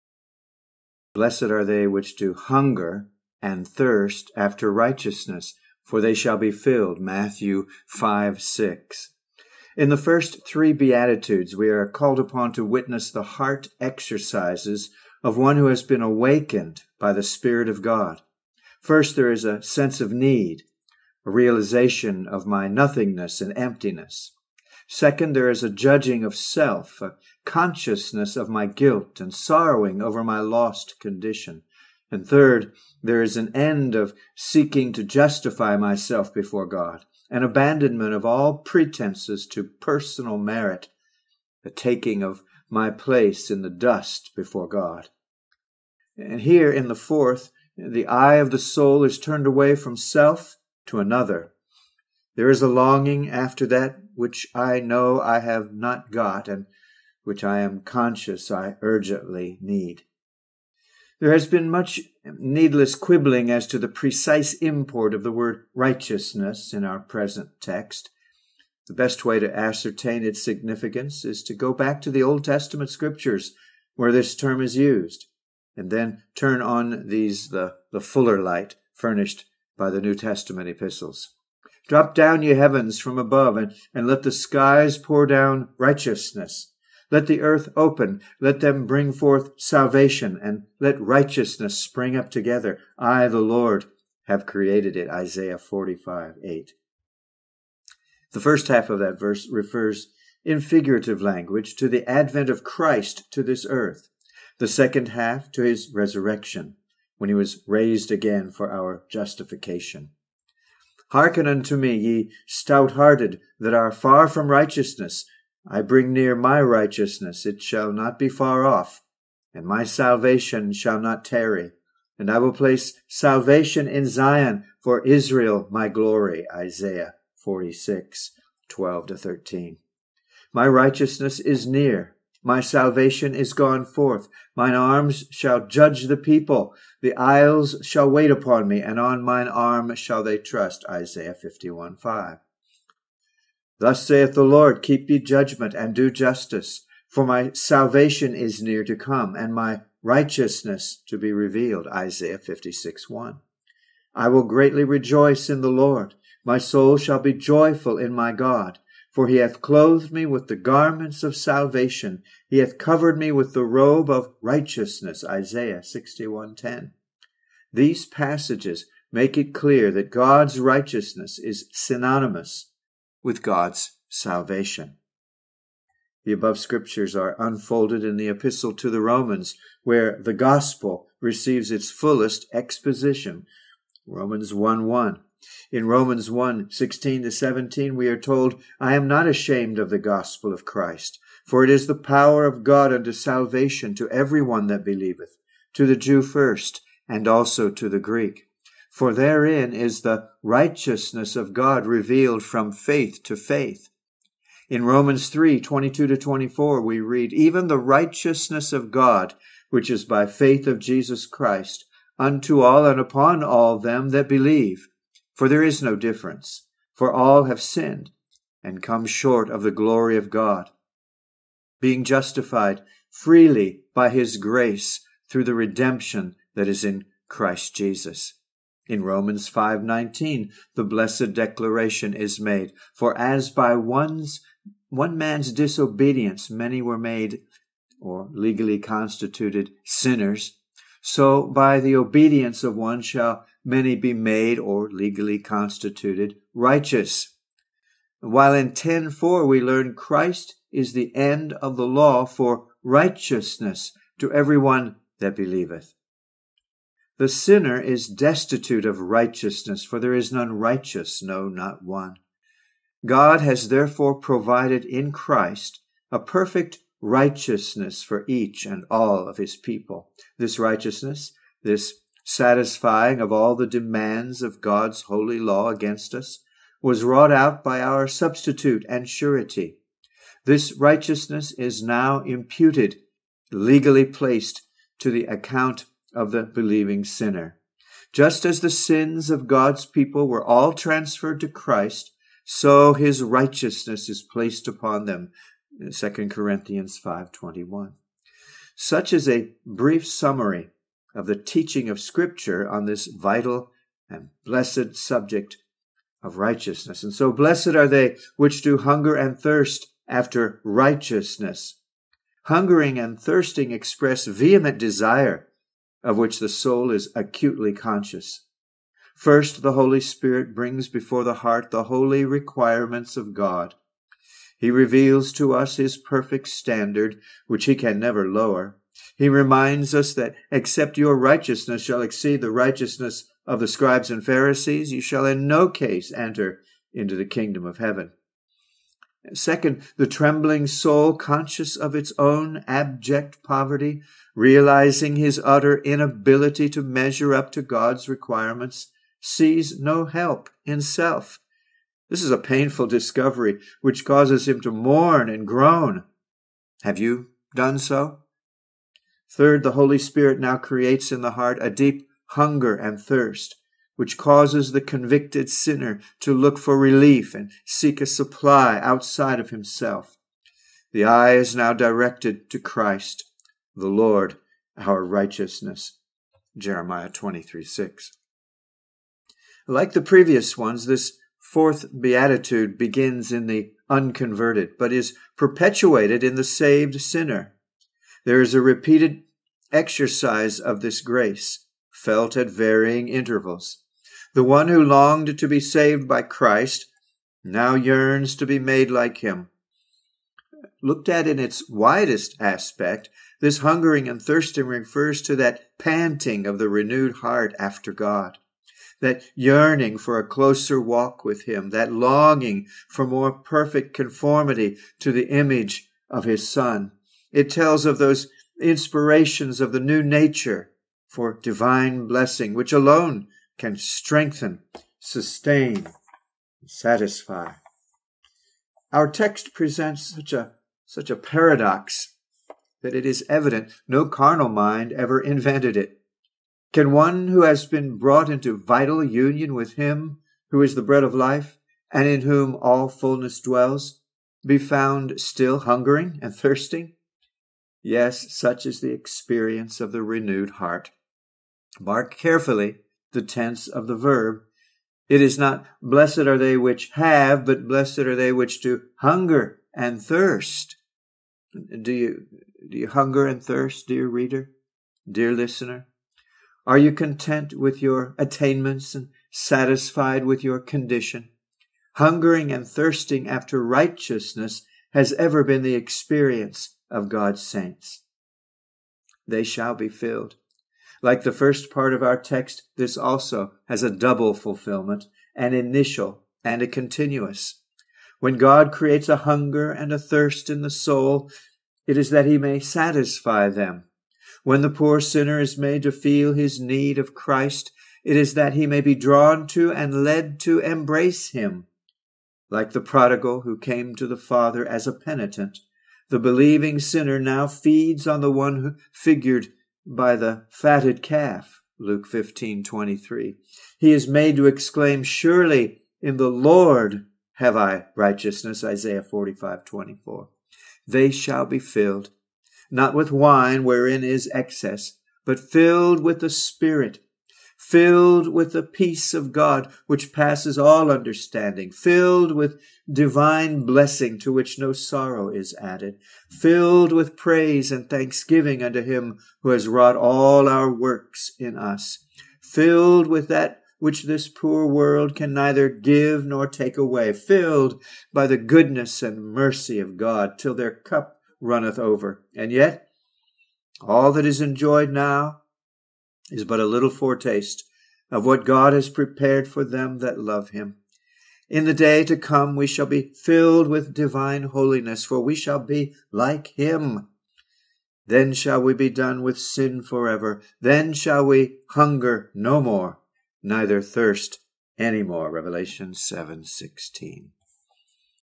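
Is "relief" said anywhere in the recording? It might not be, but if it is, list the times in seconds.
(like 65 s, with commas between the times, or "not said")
366 s.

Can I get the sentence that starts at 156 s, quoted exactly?
My soul shall be joyful in my God.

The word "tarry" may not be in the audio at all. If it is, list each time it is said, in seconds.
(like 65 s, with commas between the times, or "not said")
121 s.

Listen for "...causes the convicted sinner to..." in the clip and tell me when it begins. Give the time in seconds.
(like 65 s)
364 s.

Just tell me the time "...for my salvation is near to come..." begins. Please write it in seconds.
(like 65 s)
147 s.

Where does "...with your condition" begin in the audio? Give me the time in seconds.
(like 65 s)
470 s.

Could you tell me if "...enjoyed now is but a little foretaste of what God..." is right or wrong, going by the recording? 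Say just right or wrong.
right.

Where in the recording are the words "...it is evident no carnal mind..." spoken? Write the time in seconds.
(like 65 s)
432 s.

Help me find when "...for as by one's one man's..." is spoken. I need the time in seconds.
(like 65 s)
232 s.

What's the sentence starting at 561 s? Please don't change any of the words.
In the day to come, we shall be filled with divine holiness, for we shall be like him.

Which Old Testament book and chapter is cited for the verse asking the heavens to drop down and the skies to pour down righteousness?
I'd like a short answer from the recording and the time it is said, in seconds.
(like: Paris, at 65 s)
Isaiah 45:8, at 95 s.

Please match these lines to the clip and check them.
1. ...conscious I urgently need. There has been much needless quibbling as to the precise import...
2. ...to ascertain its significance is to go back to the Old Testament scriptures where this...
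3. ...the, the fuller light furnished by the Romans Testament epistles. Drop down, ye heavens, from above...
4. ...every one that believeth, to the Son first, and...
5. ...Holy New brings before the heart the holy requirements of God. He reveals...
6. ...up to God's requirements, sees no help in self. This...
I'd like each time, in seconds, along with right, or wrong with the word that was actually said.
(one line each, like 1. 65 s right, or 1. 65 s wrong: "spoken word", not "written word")
1. 57 s right
2. 69 s right
3. 77 s wrong: "New", not "Romans"
4. 194 s wrong: "Jew", not "Son"
5. 319 s wrong: "Spirit", not "New"
6. 347 s right.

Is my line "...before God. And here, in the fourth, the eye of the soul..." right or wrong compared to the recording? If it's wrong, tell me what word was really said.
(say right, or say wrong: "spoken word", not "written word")
right.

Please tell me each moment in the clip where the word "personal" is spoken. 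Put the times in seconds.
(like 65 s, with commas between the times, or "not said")
39 s.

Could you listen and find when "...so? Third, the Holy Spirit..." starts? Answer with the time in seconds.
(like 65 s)
357 s.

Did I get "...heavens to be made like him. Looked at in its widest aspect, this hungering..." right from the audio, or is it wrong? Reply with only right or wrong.
wrong.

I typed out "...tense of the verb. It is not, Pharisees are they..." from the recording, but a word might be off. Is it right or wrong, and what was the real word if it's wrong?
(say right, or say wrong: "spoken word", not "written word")
wrong: "Blessed", not "Pharisees".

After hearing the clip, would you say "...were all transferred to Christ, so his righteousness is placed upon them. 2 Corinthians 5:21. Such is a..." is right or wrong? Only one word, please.
right.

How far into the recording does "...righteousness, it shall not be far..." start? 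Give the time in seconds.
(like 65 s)
116 s.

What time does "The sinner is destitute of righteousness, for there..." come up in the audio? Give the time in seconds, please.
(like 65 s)
257 s.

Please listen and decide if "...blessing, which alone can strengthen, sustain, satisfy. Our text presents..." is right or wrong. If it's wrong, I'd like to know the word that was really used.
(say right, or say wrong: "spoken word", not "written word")
right.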